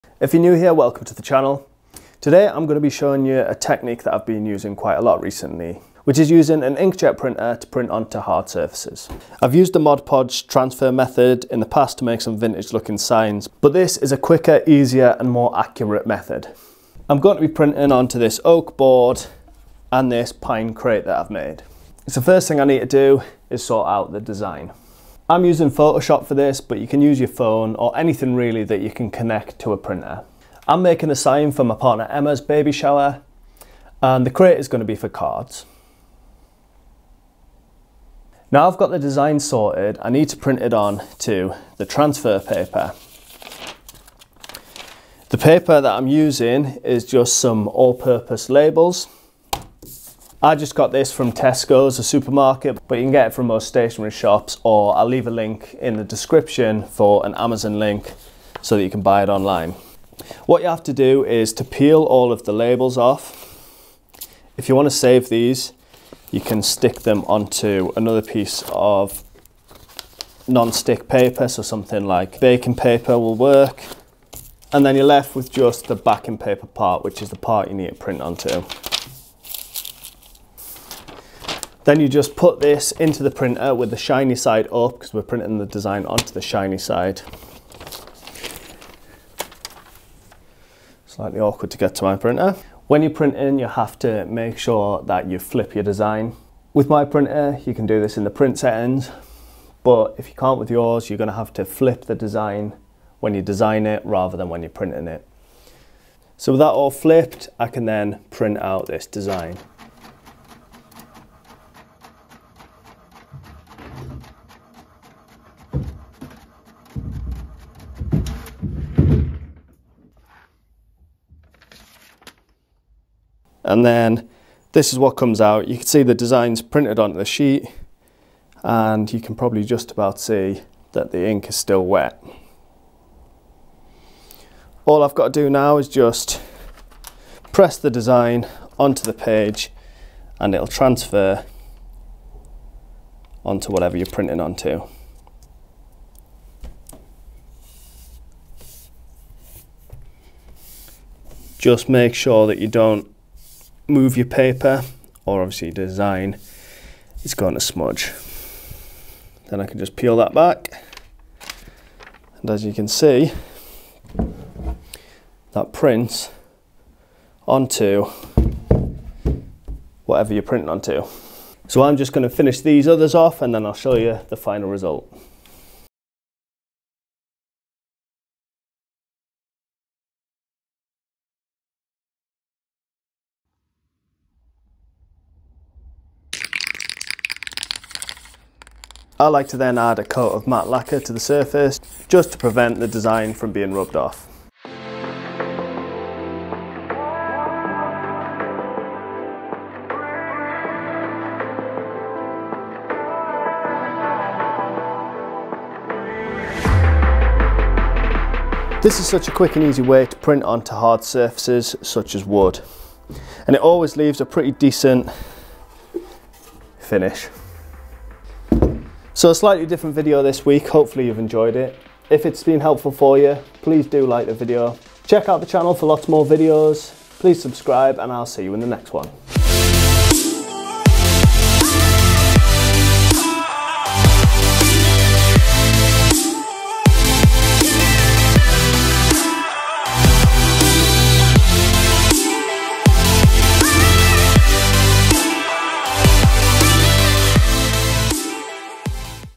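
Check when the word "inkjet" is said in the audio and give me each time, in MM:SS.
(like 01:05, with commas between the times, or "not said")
00:06.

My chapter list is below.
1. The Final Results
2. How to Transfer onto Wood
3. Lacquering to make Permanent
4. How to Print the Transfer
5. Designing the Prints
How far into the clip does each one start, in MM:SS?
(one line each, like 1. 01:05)
1. 03:18
2. 02:03
3. 03:06
4. 00:44
5. 00:32.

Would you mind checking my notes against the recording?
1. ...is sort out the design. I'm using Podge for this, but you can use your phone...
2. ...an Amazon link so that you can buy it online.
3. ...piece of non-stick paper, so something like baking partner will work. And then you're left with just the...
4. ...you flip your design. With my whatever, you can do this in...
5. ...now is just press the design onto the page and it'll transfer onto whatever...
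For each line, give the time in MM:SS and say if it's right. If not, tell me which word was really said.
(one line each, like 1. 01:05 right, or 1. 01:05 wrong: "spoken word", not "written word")
1. 00:23 wrong: "Photoshop", not "Podge"
2. 00:57 right
3. 01:08 wrong: "paper", not "partner"
4. 01:35 wrong: "printer", not "whatever"
5. 02:15 right.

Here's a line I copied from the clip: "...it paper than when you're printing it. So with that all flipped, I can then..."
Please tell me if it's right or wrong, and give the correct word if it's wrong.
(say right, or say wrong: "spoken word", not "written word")
wrong: "rather", not "paper".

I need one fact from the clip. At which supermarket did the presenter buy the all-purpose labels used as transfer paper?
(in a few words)
Tesco's.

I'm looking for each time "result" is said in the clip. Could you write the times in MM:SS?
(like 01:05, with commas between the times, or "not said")
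02:54.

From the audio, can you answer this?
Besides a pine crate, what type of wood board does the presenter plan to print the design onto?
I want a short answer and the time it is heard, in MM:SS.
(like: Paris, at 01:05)
Oak, at 00:18.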